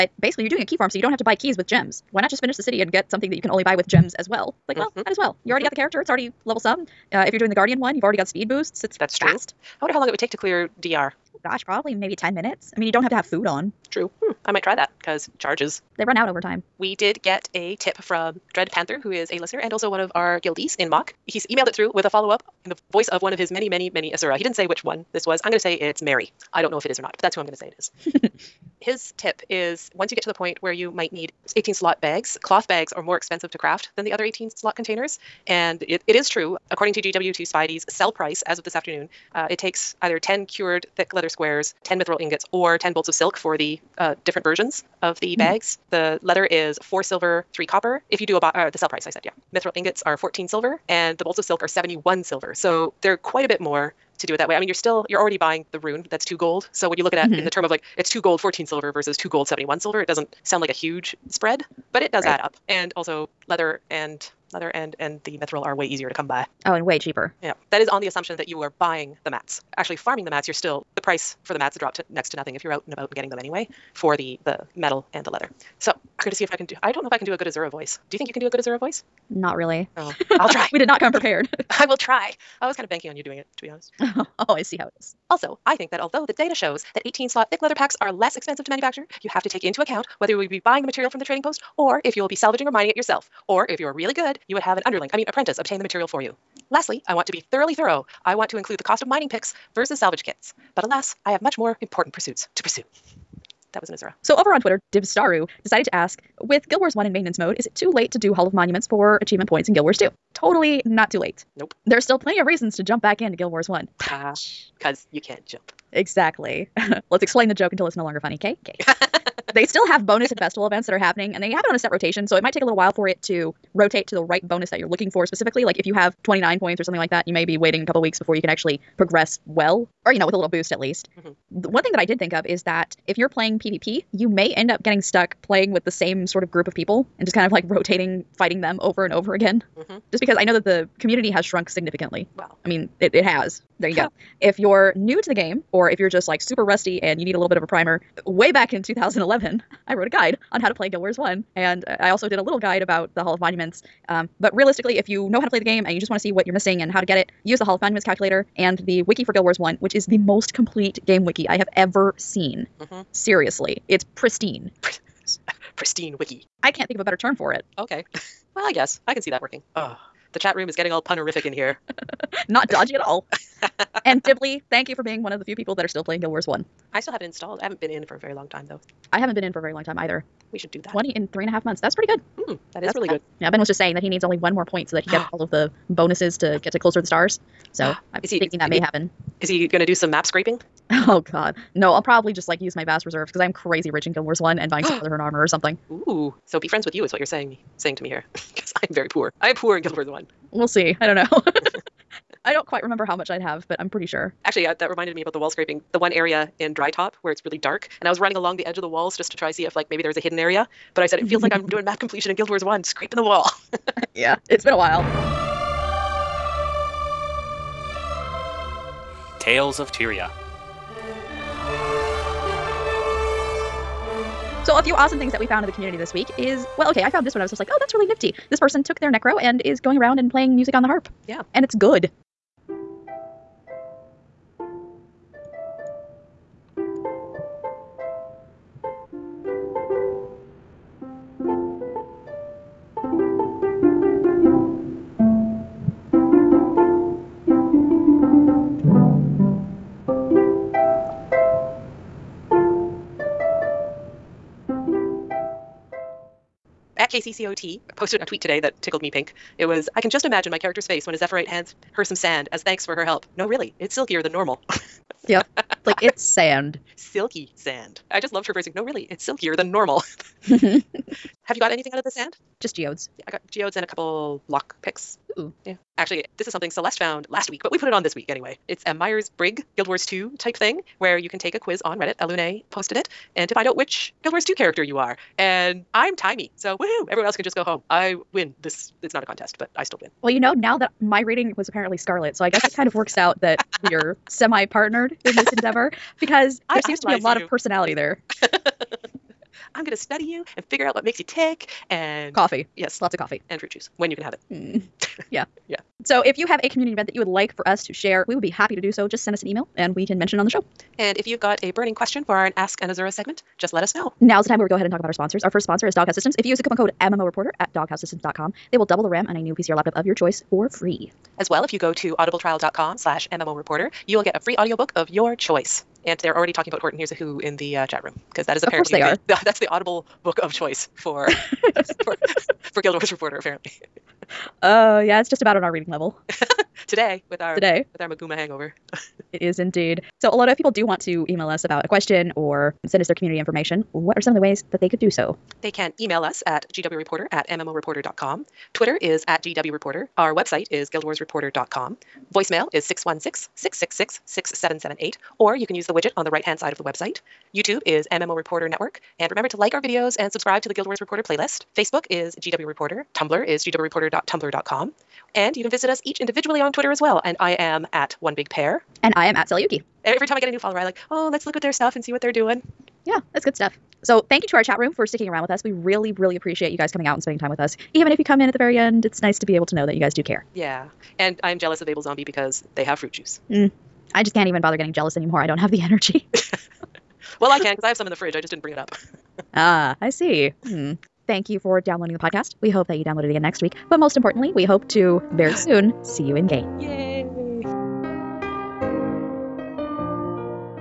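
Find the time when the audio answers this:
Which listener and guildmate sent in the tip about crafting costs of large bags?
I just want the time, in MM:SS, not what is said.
00:18.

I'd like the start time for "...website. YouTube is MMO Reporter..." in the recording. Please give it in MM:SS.
05:56.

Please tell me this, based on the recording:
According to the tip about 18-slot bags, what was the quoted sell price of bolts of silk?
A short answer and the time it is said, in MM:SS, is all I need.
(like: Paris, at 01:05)
71 silver, at 00:51.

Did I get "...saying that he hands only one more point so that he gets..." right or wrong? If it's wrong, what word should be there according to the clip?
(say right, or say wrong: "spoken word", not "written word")
wrong: "needs", not "hands".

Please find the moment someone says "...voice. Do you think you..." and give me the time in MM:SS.
01:17.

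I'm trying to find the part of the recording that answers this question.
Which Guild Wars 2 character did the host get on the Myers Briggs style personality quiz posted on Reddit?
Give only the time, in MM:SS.
04:46.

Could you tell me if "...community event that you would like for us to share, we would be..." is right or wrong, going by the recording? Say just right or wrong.
right.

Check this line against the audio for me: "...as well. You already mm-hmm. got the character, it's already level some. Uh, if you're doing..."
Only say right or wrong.
right.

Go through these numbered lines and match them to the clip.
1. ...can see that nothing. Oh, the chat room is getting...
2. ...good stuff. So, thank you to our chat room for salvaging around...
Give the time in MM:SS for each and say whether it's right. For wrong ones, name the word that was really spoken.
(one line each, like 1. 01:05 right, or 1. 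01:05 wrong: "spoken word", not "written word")
1. 02:49 wrong: "working", not "nothing"
2. 06:13 wrong: "sticking", not "salvaging".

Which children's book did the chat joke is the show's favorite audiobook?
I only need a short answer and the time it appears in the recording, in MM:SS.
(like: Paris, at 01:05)
Horton Hears a Who, at 05:26.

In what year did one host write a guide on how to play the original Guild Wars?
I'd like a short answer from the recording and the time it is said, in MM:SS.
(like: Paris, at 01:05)
2011, at 02:28.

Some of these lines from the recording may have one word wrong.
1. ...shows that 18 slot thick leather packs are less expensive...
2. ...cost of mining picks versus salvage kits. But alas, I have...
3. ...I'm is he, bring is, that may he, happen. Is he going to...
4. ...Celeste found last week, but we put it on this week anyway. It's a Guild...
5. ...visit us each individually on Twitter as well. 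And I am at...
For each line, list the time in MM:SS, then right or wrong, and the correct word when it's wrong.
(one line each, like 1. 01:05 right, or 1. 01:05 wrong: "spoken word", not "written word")
1. 01:26 right
2. 01:38 right
3. 03:08 wrong: "thinking", not "bring"
4. 04:36 wrong: "Myers", not "Guild"
5. 06:05 right.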